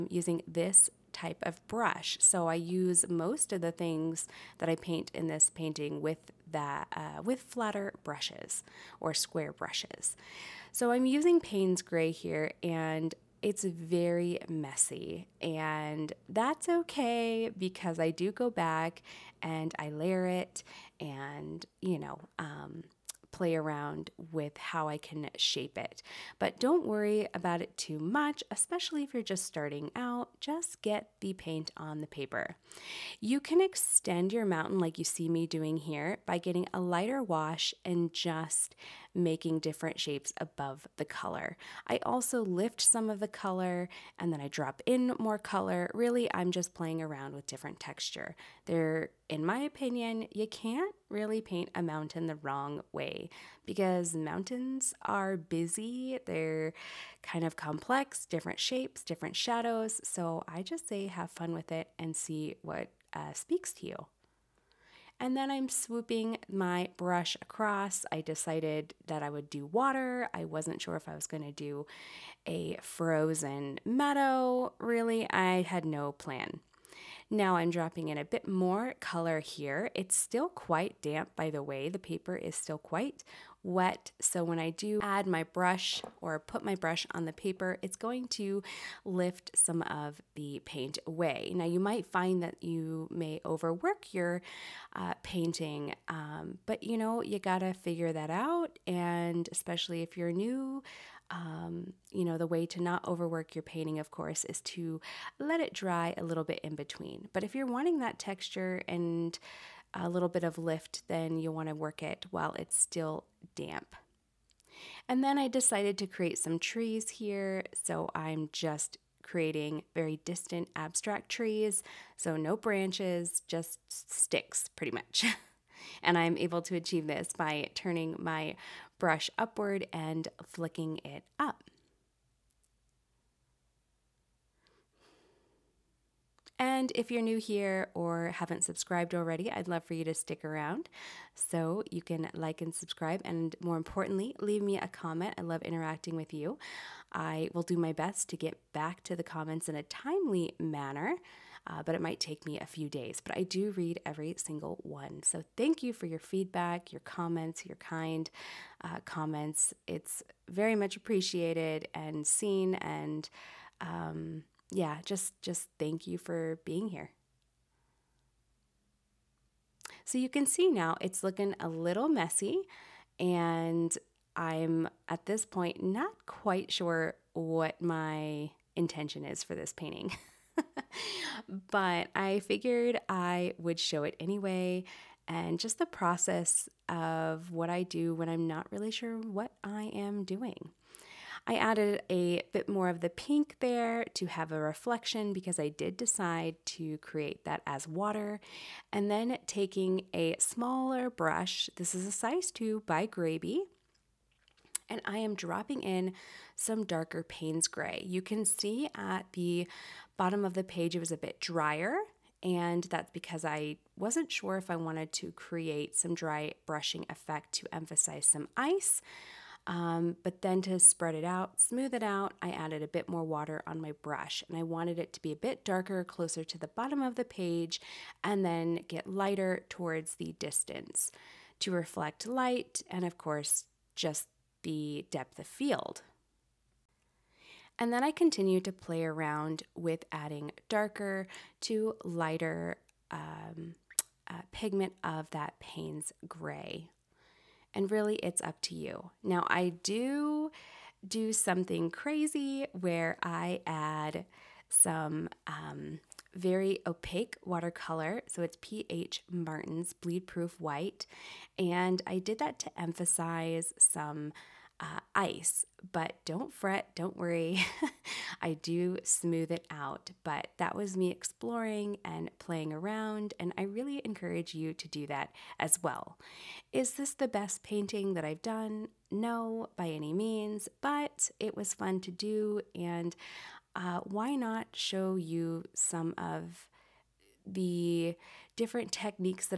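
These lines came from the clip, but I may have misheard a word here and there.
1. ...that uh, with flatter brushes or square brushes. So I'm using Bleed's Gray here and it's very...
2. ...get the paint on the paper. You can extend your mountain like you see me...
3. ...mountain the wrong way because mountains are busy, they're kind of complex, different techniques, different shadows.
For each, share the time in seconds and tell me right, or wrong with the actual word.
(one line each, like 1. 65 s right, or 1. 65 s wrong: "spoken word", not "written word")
1. 6 s wrong: "Payne", not "Bleed"
2. 30 s right
3. 51 s wrong: "shapes", not "techniques".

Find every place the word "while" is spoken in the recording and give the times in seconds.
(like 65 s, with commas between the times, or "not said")
112 s.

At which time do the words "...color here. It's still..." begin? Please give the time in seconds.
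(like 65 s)
78 s.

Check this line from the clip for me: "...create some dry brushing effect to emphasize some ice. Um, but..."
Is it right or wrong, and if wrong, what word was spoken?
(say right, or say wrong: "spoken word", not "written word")
right.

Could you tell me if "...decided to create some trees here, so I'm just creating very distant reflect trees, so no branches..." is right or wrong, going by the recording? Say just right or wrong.
wrong.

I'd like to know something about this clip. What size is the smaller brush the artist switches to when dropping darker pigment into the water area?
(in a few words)
2.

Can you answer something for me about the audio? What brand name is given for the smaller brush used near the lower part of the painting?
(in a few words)
Grabie.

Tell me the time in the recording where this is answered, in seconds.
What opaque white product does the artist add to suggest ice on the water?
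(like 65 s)
259 s.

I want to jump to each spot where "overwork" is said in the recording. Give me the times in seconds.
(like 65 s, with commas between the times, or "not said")
93 s, 103 s.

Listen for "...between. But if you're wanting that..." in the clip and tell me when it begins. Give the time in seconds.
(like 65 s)
106 s.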